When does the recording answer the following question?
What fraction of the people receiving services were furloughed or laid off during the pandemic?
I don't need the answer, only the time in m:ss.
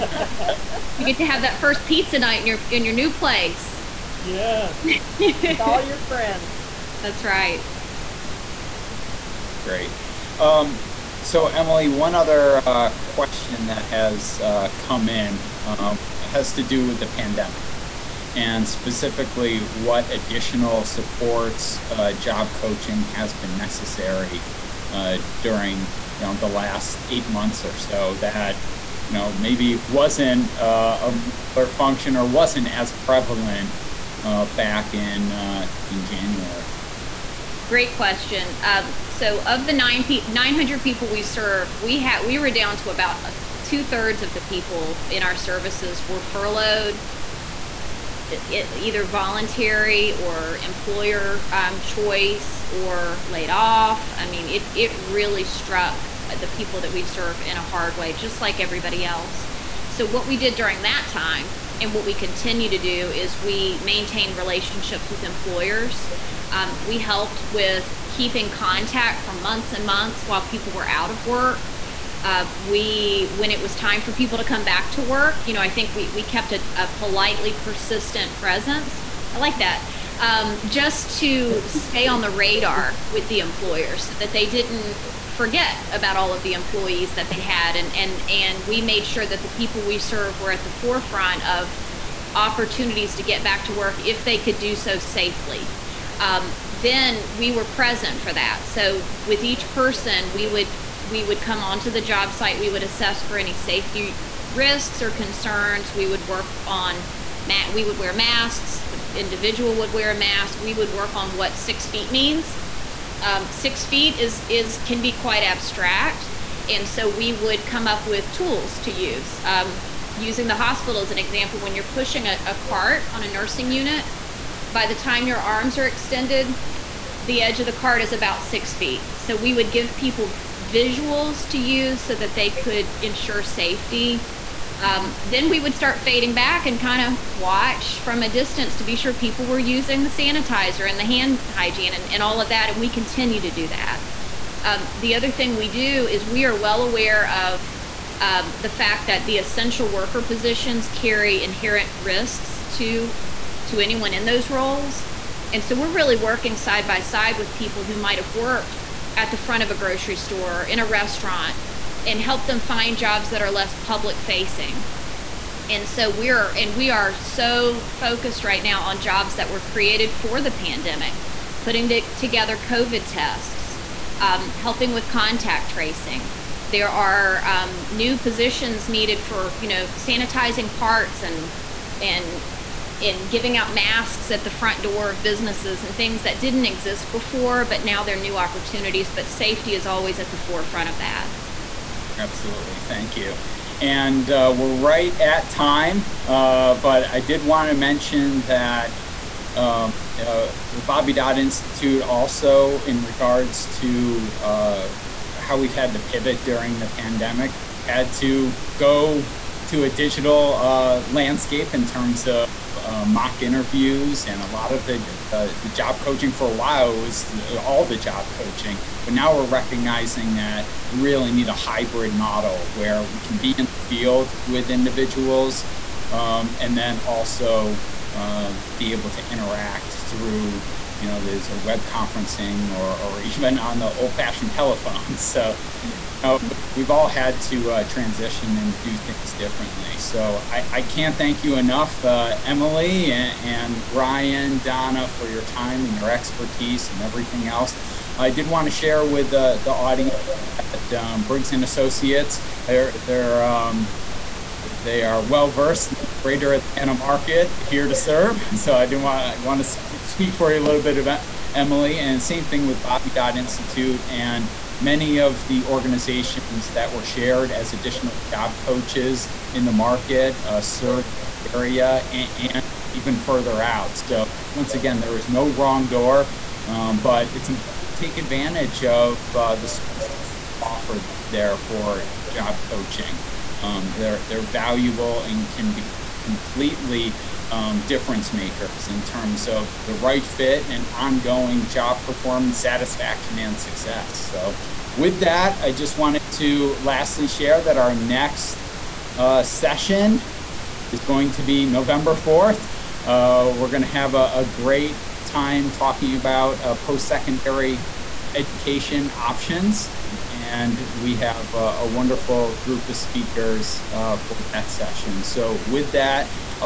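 0:43.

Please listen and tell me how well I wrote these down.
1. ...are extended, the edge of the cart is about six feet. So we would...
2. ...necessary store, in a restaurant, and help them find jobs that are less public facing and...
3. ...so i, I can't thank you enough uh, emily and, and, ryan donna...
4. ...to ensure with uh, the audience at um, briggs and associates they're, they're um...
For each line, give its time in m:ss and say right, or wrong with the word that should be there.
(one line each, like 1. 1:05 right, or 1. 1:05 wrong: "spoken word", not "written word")
1. 2:05 right
2. 2:39 wrong: "grocery", not "necessary"
3. 3:59 right
4. 4:08 wrong: "share", not "ensure".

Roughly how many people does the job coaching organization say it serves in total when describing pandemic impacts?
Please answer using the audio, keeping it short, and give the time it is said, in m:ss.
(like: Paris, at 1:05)
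900, at 0:40.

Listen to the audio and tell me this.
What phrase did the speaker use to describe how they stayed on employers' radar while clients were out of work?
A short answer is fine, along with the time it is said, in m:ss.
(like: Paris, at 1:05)
politely persistent presence, at 1:16.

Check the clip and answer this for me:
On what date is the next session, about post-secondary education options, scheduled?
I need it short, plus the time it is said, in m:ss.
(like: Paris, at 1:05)
November 4th, at 5:01.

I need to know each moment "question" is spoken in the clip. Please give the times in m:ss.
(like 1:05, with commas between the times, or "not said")
0:12, 0:37.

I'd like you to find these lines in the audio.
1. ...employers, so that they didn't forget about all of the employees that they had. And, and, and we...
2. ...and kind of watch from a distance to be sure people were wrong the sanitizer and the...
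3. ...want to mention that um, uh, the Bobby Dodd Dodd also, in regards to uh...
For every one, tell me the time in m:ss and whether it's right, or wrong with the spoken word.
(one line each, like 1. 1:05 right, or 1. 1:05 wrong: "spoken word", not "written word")
1. 1:23 right
2. 2:16 wrong: "using", not "wrong"
3. 3:17 wrong: "Institute", not "Dodd".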